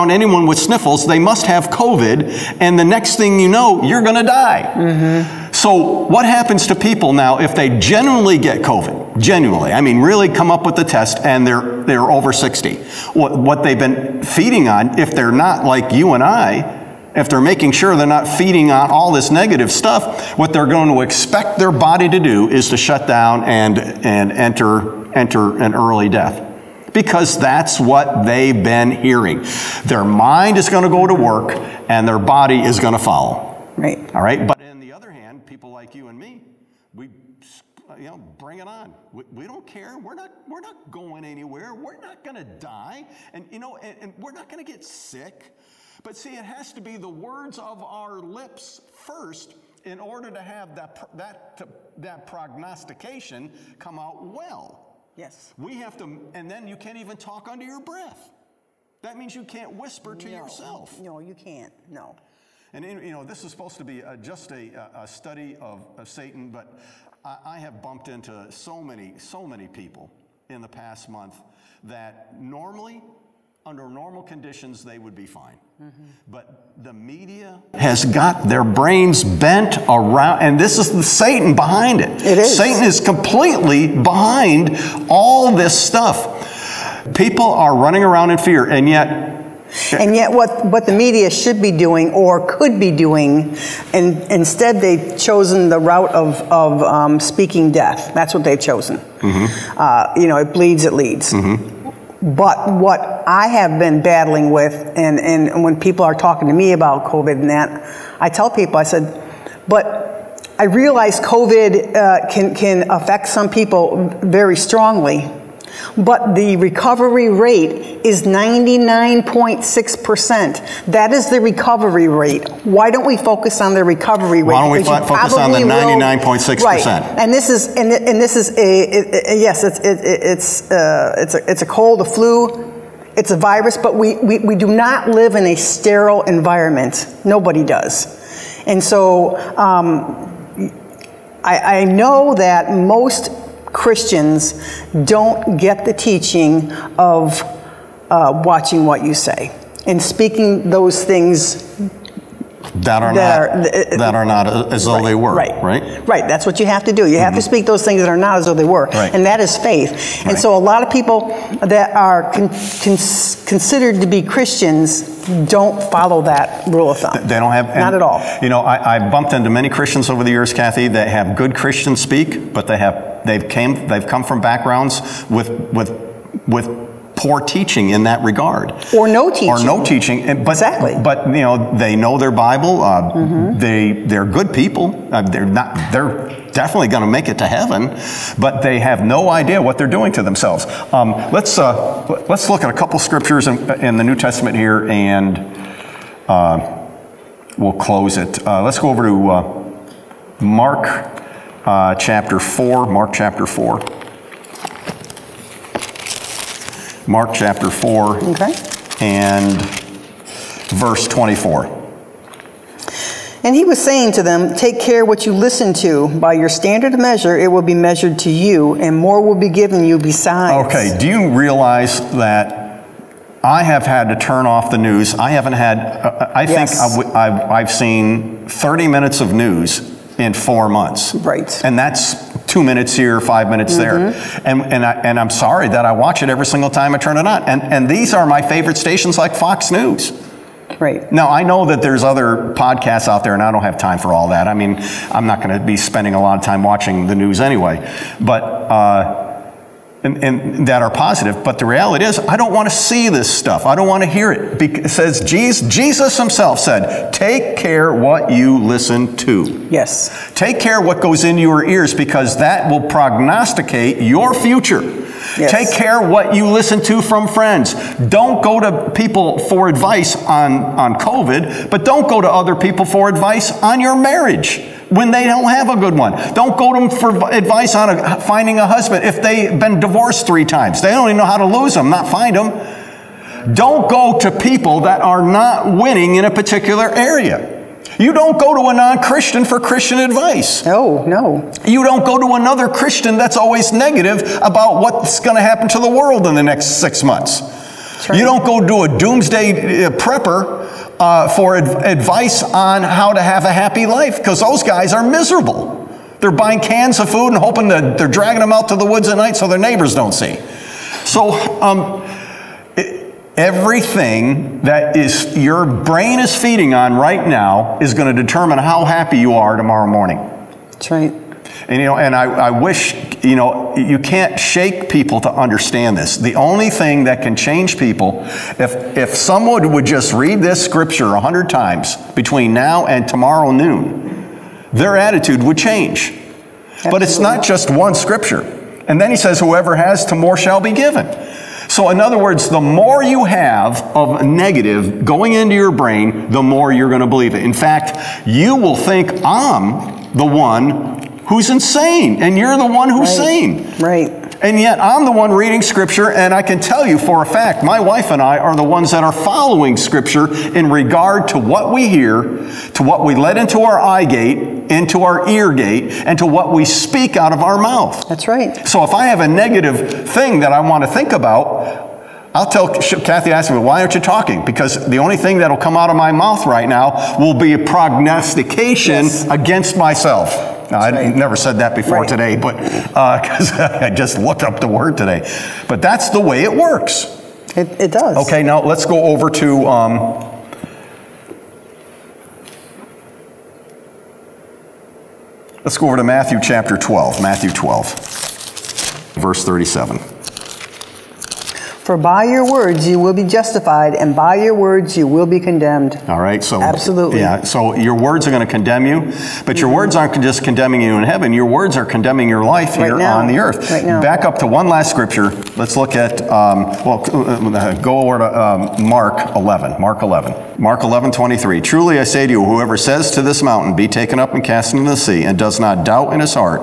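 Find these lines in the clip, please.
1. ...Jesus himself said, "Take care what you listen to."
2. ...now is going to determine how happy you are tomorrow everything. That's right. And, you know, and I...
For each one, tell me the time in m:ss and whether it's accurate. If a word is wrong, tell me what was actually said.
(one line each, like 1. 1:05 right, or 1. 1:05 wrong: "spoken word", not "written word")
1. 4:15 right
2. 5:17 wrong: "morning", not "everything".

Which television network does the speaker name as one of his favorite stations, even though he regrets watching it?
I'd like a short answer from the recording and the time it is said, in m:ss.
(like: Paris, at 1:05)
Fox News, at 3:59.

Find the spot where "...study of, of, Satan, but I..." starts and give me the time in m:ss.
1:05.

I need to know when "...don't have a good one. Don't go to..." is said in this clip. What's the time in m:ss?
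4:35.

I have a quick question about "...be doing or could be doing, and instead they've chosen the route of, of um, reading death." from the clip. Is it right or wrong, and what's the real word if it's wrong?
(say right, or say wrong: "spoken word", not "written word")
wrong: "speaking", not "reading".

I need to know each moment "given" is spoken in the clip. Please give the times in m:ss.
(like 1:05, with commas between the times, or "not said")
3:39, 5:40.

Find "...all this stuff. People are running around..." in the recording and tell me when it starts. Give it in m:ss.
1:25.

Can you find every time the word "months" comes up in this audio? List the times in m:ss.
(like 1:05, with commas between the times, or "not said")
1:11, 3:50, 4:57.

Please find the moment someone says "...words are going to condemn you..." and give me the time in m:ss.
6:47.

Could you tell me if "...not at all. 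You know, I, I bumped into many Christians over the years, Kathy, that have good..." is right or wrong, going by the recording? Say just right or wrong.
right.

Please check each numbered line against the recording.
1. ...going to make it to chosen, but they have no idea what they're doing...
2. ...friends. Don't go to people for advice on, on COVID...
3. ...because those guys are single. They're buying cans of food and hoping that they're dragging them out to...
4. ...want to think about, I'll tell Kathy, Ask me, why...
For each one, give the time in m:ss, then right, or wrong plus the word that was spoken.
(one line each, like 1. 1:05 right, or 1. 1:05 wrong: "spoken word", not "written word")
1. 3:06 wrong: "heaven", not "chosen"
2. 4:27 right
3. 5:04 wrong: "miserable", not "single"
4. 6:10 right.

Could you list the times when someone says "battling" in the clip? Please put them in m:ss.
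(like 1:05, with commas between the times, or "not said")
1:44.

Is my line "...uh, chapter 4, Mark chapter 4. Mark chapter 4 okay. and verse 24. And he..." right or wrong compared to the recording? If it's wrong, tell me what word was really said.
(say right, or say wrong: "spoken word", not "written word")
right.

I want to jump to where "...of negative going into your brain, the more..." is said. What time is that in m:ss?
5:43.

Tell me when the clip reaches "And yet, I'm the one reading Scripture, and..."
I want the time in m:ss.
5:54.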